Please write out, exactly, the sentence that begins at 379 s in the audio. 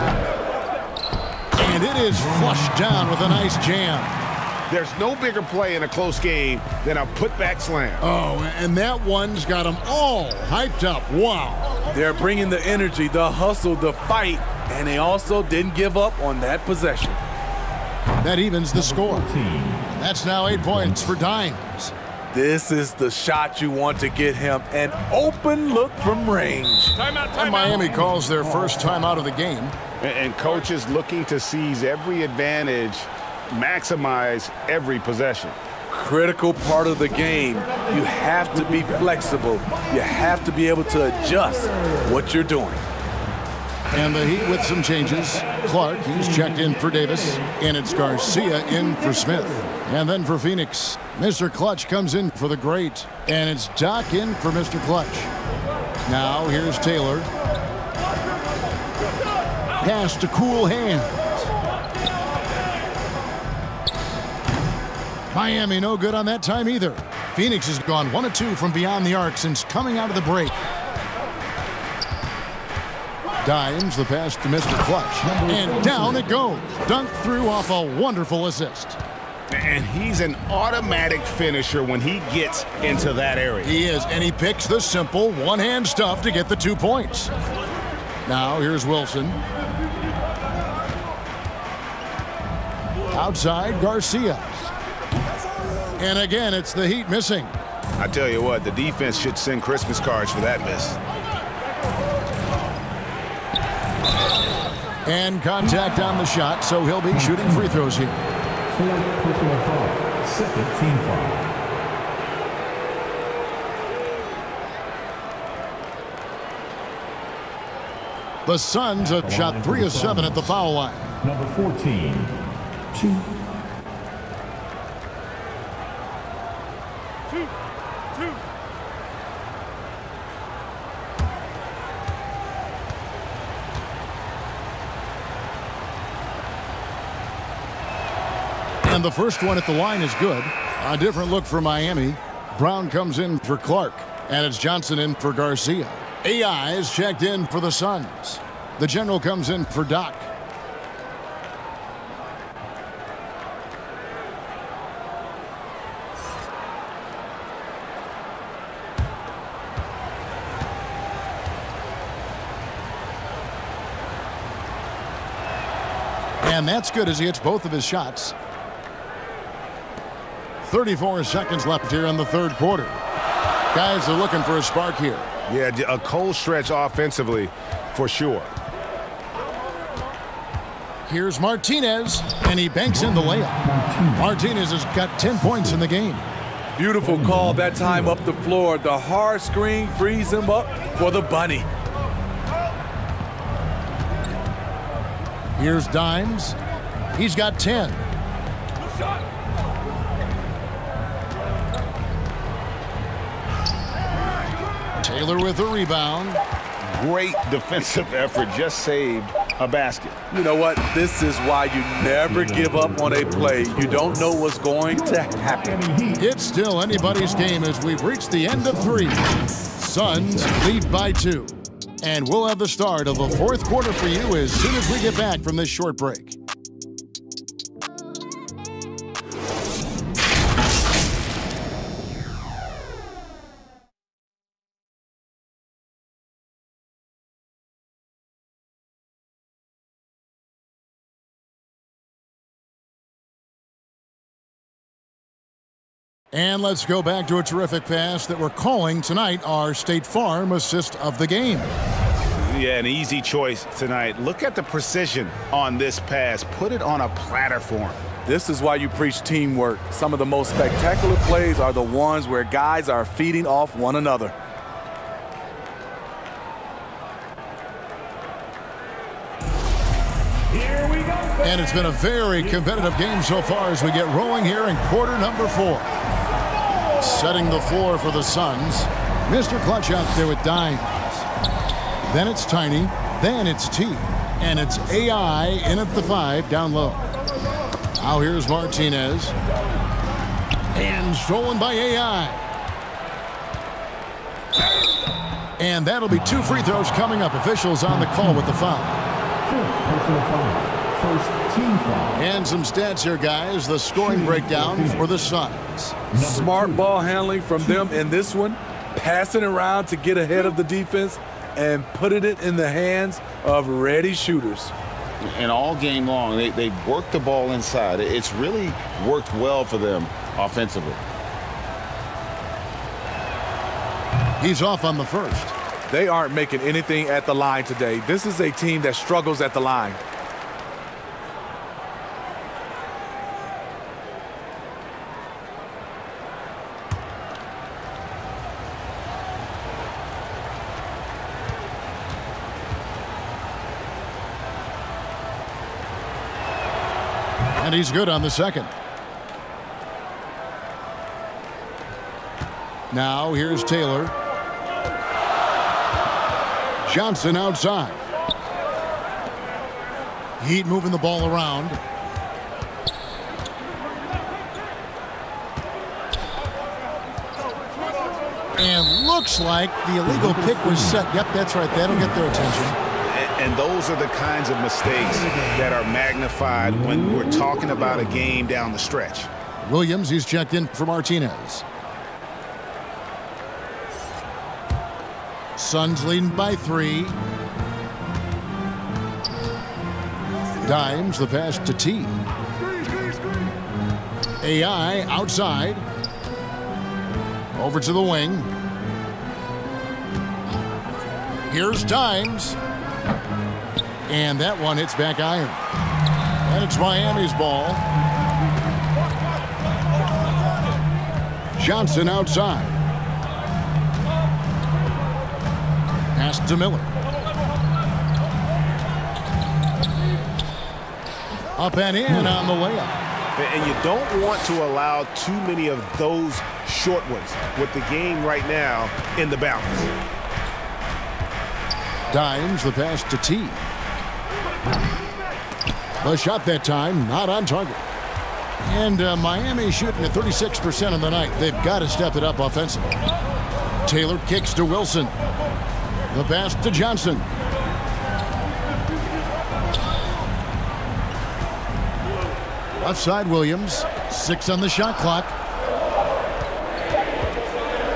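Williams, he's checked in for Martinez.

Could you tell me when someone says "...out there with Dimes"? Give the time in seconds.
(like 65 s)
279 s.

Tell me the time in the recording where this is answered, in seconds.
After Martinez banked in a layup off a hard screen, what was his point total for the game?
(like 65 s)
185 s.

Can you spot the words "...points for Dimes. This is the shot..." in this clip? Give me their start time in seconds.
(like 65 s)
20 s.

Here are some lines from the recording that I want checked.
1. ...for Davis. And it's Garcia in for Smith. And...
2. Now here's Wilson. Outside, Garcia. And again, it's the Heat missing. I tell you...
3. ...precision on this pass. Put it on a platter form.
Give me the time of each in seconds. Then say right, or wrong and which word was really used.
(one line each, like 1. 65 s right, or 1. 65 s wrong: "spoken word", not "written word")
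1. 46 s right
2. 88 s right
3. 254 s right.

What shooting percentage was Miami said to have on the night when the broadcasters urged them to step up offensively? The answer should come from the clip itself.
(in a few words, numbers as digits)
36%.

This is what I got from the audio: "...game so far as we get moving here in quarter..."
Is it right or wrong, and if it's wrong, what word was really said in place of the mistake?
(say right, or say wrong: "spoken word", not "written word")
wrong: "rolling", not "moving".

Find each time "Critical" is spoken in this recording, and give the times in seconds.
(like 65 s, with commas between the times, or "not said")
35 s.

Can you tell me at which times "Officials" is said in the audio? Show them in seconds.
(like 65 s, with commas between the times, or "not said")
297 s.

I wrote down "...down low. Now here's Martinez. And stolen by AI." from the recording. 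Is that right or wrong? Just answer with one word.
right.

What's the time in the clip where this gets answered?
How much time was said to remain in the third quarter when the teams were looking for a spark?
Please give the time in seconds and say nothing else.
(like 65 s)
170 s.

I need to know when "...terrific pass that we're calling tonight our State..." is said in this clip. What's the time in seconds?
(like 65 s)
247 s.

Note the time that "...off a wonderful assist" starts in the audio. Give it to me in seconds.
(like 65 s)
77 s.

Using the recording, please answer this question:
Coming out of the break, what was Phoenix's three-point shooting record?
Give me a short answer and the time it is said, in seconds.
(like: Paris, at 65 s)
1-2, at 68 s.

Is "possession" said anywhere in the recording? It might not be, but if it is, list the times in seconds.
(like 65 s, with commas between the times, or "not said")
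16 s, 34 s.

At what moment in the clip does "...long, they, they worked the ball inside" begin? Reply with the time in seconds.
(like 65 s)
316 s.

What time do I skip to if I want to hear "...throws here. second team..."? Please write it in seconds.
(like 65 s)
107 s.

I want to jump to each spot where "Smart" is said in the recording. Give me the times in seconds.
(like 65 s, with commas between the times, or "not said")
306 s.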